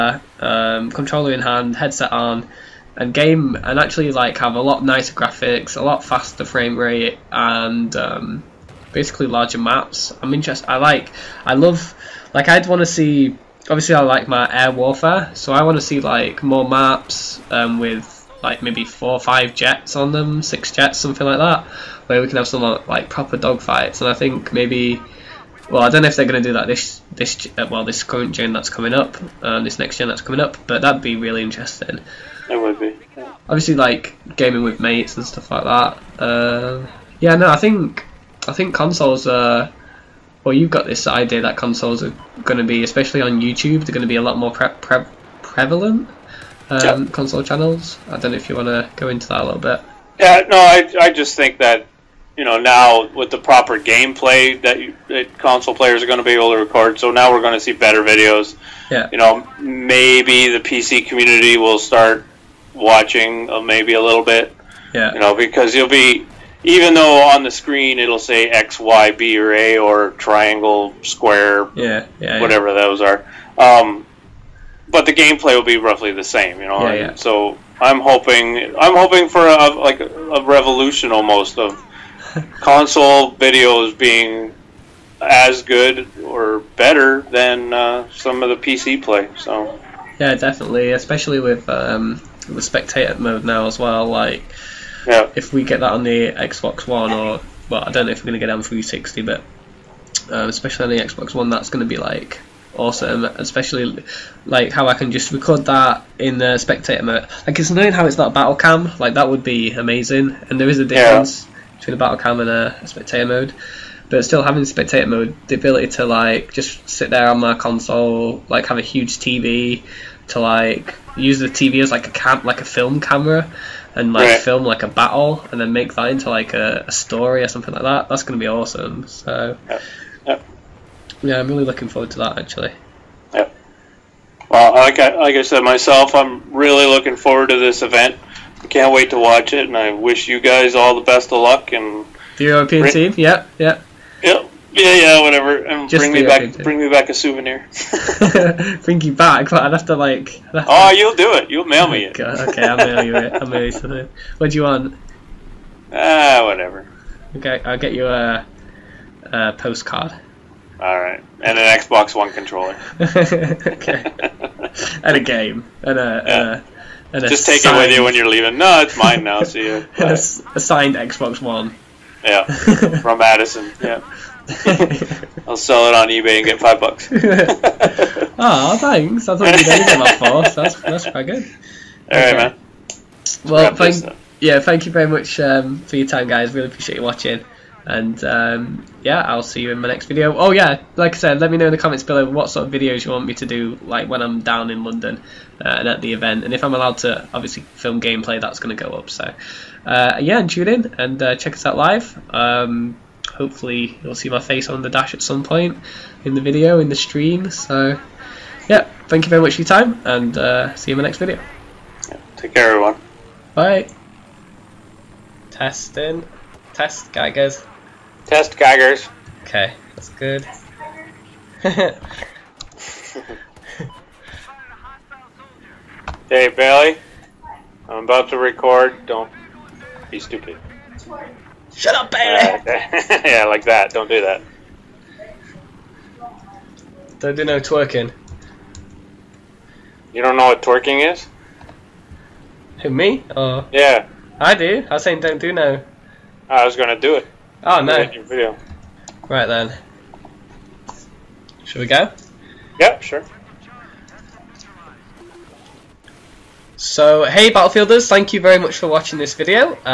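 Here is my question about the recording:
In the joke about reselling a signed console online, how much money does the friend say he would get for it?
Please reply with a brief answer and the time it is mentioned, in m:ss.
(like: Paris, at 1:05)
5 bucks, at 2:56.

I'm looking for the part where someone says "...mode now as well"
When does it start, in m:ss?
1:33.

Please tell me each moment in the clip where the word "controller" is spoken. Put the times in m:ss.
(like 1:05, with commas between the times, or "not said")
0:00, 2:42.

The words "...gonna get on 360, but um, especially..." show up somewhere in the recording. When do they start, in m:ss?
1:38.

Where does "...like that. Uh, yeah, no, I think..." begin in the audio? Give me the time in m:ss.
0:35.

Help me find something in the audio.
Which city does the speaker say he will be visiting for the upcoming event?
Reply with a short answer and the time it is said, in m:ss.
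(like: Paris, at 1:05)
London, at 3:14.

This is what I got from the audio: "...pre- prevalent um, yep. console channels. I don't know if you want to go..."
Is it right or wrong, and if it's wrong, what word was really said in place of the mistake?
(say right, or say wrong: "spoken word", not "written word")
right.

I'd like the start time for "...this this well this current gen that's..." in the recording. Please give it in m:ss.
0:26.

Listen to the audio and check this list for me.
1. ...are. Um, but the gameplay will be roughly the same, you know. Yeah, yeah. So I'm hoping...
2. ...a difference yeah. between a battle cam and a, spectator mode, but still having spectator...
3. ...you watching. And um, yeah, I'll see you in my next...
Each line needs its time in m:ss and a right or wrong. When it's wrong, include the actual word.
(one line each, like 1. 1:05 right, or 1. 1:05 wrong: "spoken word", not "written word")
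1. 1:13 right
2. 1:50 right
3. 3:06 right.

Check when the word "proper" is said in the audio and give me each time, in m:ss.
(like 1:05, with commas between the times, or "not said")
0:23, 0:53.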